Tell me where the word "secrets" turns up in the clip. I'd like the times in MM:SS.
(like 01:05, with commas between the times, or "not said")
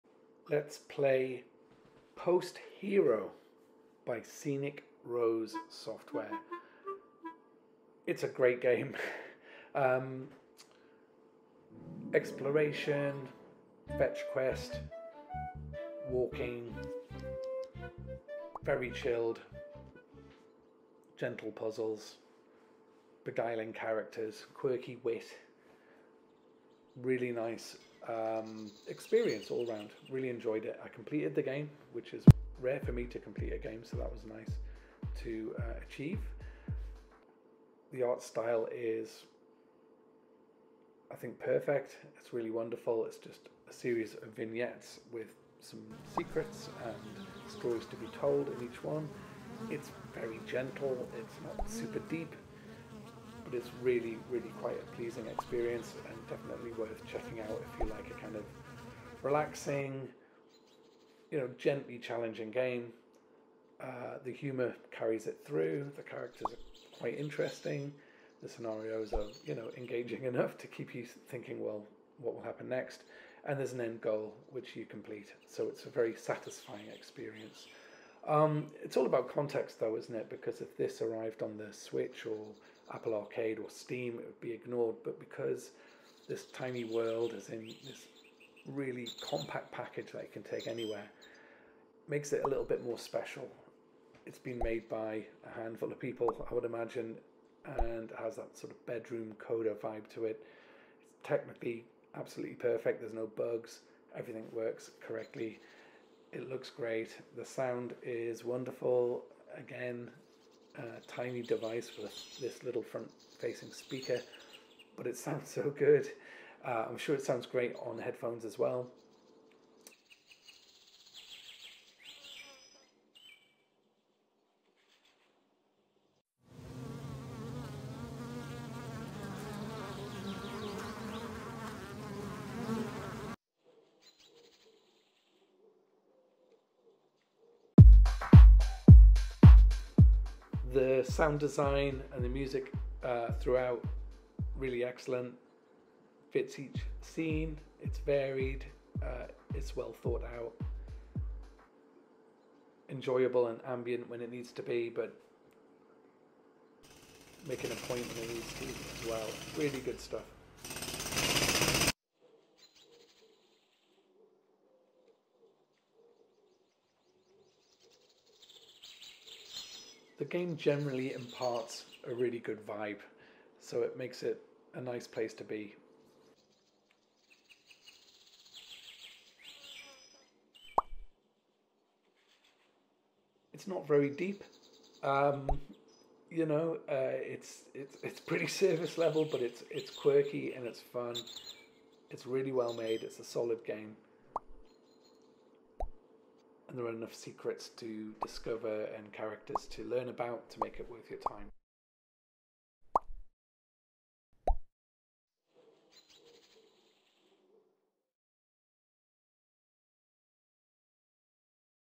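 00:46, 03:17.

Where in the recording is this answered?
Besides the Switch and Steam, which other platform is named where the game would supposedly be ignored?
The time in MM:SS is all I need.
01:22.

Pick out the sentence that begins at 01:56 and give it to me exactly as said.
Uh, I'm sure it sounds great on headphones as well.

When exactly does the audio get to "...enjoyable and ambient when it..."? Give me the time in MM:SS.
02:32.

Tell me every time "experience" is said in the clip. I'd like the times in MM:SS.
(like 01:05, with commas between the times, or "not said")
00:28, 00:55, 01:16.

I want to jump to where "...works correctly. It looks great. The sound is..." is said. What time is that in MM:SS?
01:44.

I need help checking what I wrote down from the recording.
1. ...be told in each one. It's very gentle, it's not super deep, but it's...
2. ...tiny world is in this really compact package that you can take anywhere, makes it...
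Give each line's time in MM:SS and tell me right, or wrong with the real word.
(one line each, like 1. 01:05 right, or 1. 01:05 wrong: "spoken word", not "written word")
1. 00:47 right
2. 01:26 right.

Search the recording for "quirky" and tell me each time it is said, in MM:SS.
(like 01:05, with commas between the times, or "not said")
00:24, 03:09.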